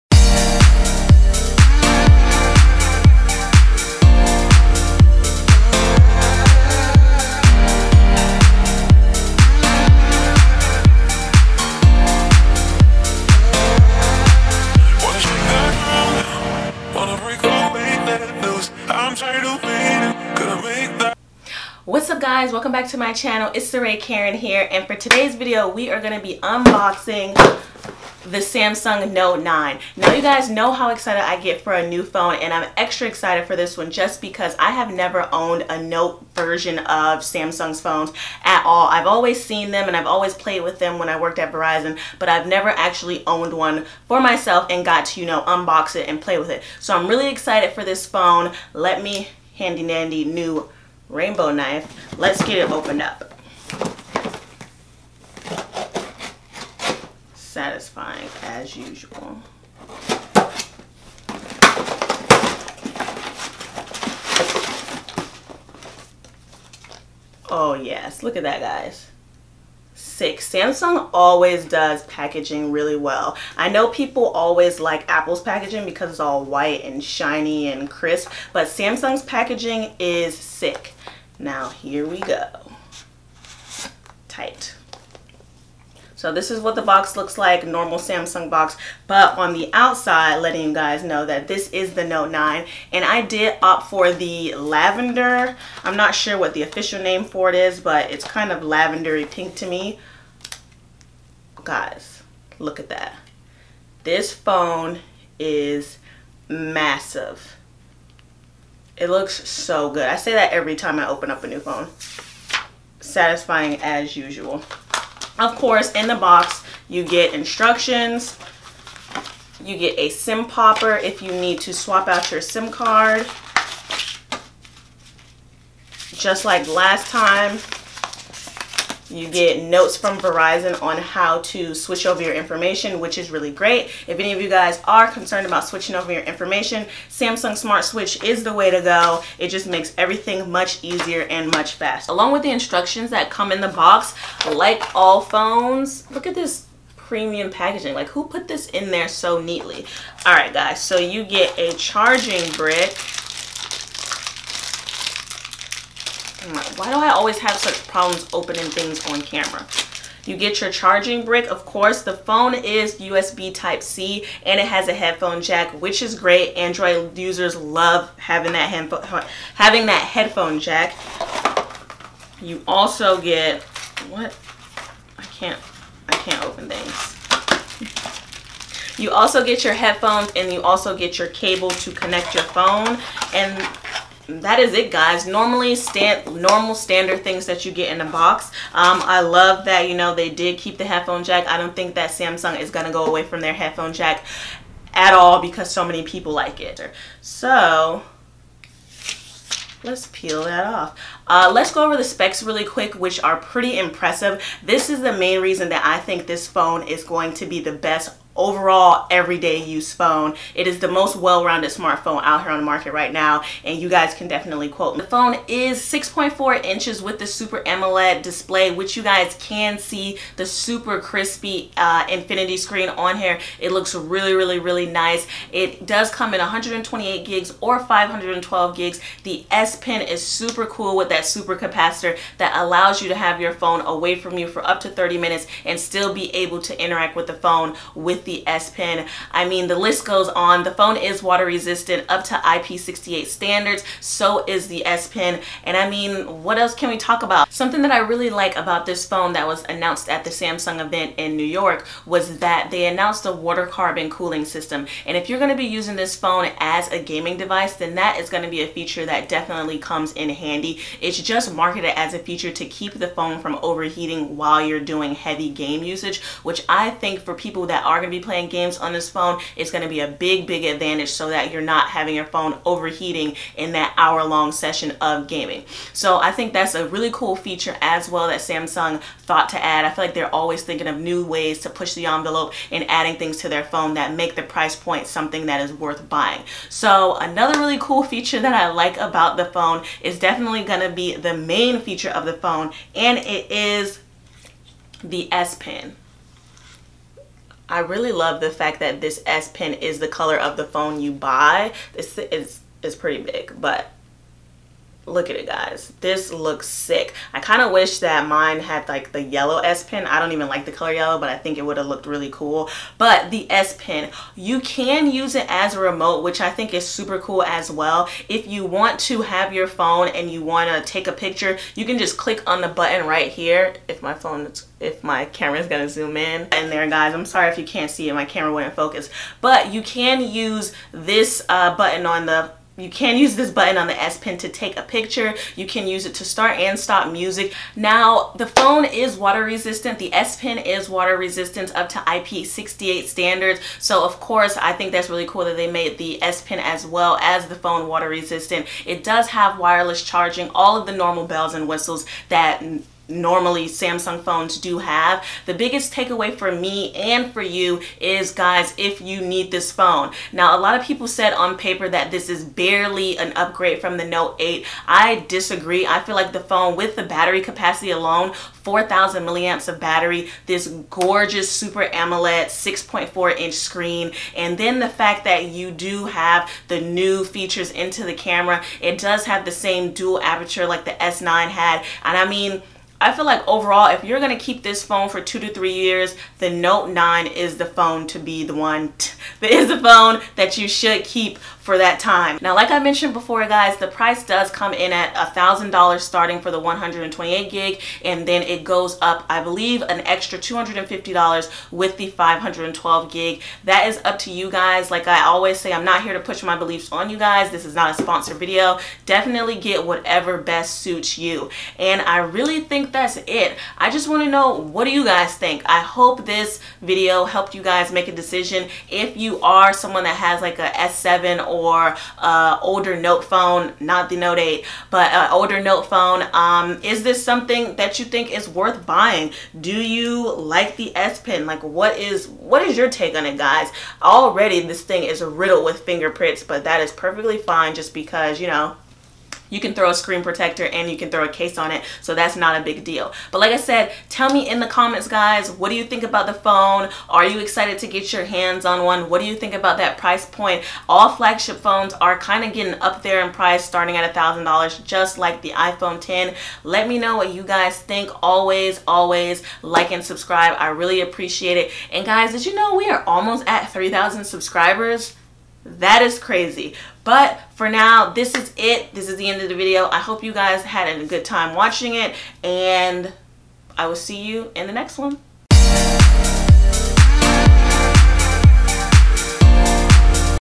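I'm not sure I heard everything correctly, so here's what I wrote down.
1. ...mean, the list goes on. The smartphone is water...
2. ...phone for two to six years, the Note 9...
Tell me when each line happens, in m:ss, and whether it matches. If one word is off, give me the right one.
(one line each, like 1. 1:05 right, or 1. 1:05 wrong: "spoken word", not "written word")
1. 3:59 wrong: "phone", not "smartphone"
2. 6:24 wrong: "three", not "six".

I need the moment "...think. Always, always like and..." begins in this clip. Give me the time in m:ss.
7:37.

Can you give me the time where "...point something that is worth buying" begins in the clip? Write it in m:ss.
4:44.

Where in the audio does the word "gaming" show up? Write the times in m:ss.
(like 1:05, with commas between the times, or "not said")
4:17, 4:35.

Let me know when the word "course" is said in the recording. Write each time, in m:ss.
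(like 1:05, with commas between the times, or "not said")
1:55, 2:41, 5:44.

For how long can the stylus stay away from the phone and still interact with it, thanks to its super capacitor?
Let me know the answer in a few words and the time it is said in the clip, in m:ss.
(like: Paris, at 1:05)
30 minutes, at 3:54.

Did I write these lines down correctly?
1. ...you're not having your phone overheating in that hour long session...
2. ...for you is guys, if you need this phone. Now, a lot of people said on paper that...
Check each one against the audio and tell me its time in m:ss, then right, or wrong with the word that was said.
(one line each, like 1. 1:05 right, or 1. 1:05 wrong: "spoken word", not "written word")
1. 4:31 right
2. 5:57 right.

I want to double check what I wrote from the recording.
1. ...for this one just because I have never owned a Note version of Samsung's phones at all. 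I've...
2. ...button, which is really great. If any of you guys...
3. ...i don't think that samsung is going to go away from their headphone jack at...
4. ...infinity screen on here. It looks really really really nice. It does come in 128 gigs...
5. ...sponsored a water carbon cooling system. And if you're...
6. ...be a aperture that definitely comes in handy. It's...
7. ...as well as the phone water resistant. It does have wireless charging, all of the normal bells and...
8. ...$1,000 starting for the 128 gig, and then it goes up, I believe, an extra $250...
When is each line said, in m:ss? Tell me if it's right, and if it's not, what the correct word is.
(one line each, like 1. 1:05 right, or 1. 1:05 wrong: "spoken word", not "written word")
1. 0:33 right
2. 2:12 wrong: "information", not "button"
3. 3:11 right
4. 3:42 right
5. 4:12 wrong: "announced", not "sponsored"
6. 4:18 wrong: "feature", not "aperture"
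7. 5:46 right
8. 6:35 right.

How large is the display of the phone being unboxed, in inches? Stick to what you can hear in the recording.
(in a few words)
6.4 inches.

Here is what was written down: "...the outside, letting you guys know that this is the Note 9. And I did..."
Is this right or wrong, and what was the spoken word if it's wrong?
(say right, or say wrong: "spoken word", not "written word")
right.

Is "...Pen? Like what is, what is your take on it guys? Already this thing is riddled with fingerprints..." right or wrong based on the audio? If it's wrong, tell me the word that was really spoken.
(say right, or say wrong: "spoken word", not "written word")
right.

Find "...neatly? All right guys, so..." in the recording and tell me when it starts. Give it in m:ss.
2:29.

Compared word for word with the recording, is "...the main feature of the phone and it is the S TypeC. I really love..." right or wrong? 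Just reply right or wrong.
wrong.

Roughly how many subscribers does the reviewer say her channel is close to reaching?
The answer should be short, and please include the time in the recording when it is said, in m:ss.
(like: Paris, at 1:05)
3,000, at 7:43.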